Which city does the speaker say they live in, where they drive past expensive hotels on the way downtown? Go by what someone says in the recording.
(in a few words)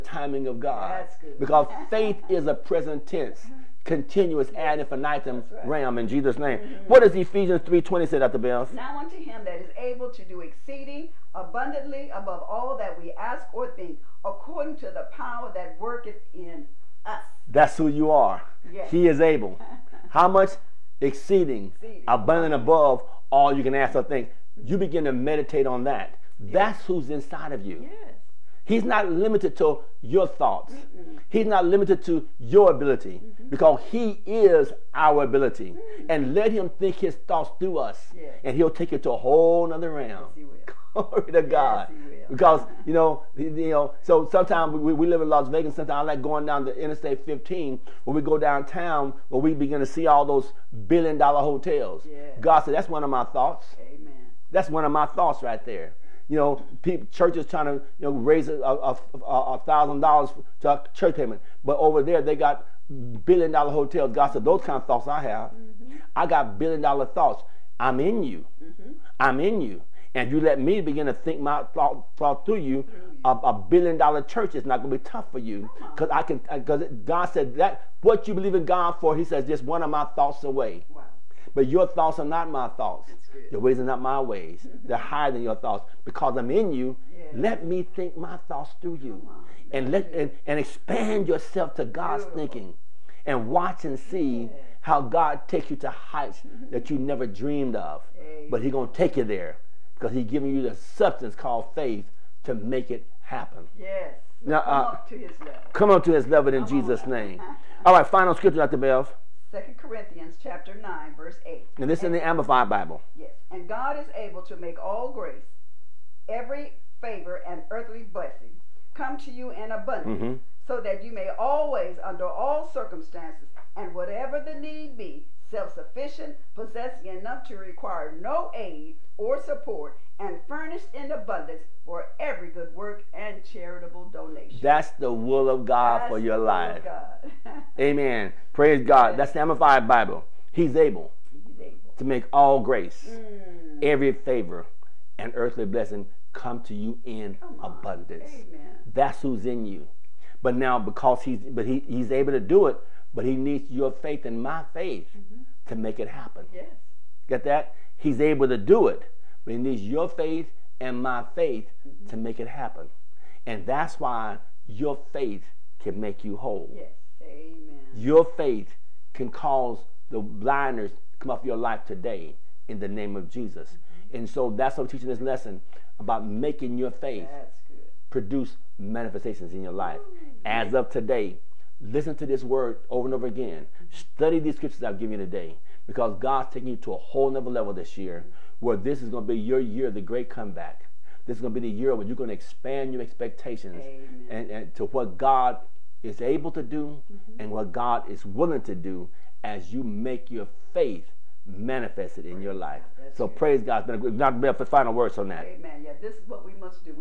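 Las Vegas.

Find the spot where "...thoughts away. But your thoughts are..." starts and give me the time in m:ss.
1:20.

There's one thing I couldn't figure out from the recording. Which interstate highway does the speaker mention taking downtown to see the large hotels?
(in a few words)
Interstate 15.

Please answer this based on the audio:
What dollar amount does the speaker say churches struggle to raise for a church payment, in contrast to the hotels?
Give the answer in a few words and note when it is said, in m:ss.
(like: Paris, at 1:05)
$1,000, at 0:58.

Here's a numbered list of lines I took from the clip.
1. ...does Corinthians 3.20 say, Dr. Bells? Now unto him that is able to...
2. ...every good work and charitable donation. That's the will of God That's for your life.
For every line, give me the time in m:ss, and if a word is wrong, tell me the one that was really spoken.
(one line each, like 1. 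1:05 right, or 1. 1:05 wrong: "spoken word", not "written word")
1. 0:07 wrong: "Ephesians", not "Corinthians"
2. 2:12 right.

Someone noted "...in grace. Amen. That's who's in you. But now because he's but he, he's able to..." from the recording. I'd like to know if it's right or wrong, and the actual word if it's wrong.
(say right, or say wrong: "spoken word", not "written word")
wrong: "abundance", not "grace".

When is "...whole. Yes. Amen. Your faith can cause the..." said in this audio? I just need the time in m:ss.
2:46.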